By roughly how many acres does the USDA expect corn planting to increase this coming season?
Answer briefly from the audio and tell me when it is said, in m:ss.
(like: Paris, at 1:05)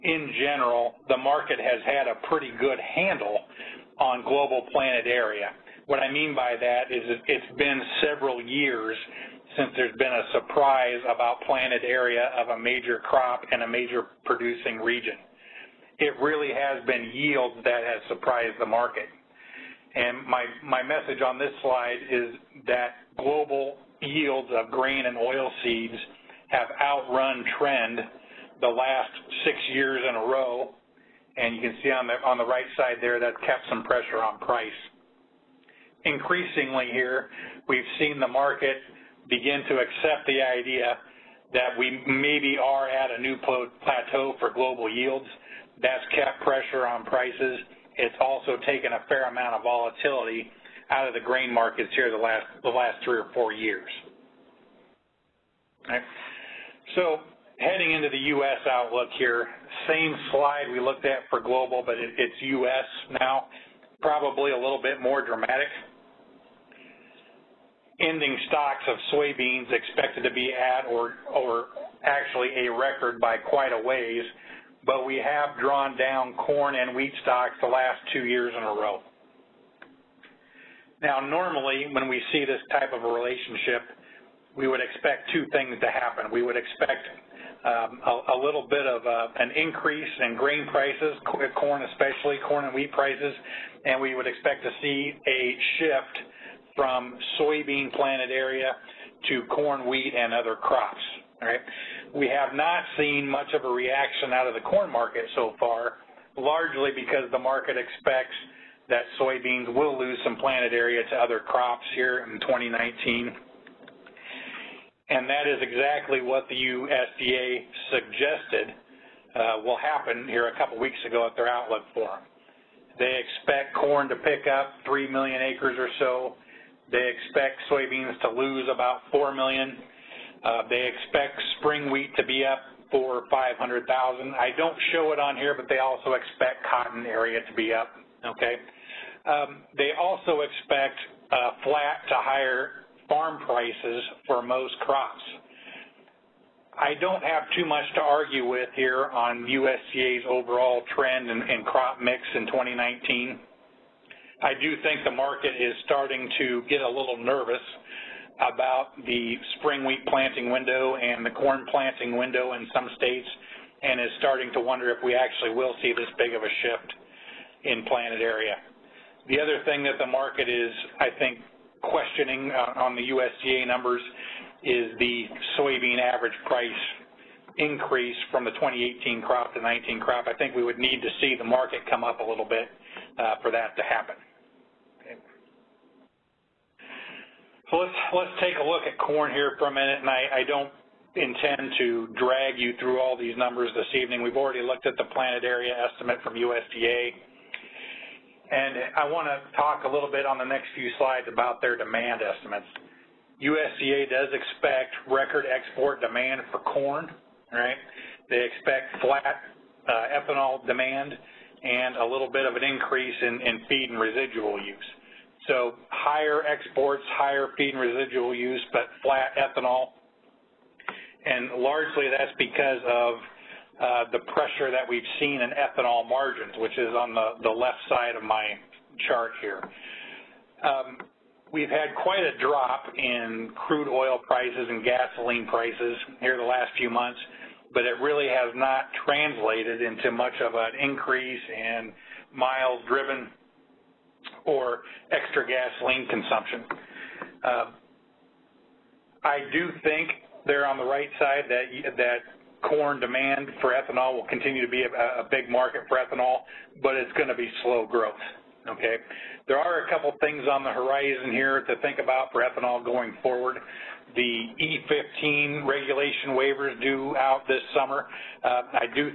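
3 million, at 2:04.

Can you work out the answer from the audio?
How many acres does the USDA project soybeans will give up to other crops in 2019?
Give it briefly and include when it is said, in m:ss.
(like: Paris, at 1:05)
4 million, at 2:09.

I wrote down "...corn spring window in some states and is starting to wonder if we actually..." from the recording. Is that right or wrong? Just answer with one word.
wrong.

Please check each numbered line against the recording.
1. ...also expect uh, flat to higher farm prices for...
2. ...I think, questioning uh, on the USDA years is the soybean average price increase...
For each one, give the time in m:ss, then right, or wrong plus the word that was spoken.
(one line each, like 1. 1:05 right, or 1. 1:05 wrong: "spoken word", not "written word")
1. 2:19 right
2. 2:50 wrong: "numbers", not "years".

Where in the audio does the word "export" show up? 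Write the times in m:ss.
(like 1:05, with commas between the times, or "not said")
3:25, 3:36.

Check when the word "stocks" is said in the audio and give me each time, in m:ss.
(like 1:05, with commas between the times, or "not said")
1:08, 1:17.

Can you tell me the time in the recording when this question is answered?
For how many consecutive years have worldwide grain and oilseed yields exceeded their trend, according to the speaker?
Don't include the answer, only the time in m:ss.
0:29.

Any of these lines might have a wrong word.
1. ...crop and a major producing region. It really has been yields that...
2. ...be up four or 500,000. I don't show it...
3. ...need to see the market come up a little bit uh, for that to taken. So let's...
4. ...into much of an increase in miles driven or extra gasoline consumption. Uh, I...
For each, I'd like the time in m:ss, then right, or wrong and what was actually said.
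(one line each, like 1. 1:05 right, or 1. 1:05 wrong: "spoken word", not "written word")
1. 0:13 right
2. 2:12 right
3. 3:00 wrong: "happen", not "taken"
4. 3:59 right.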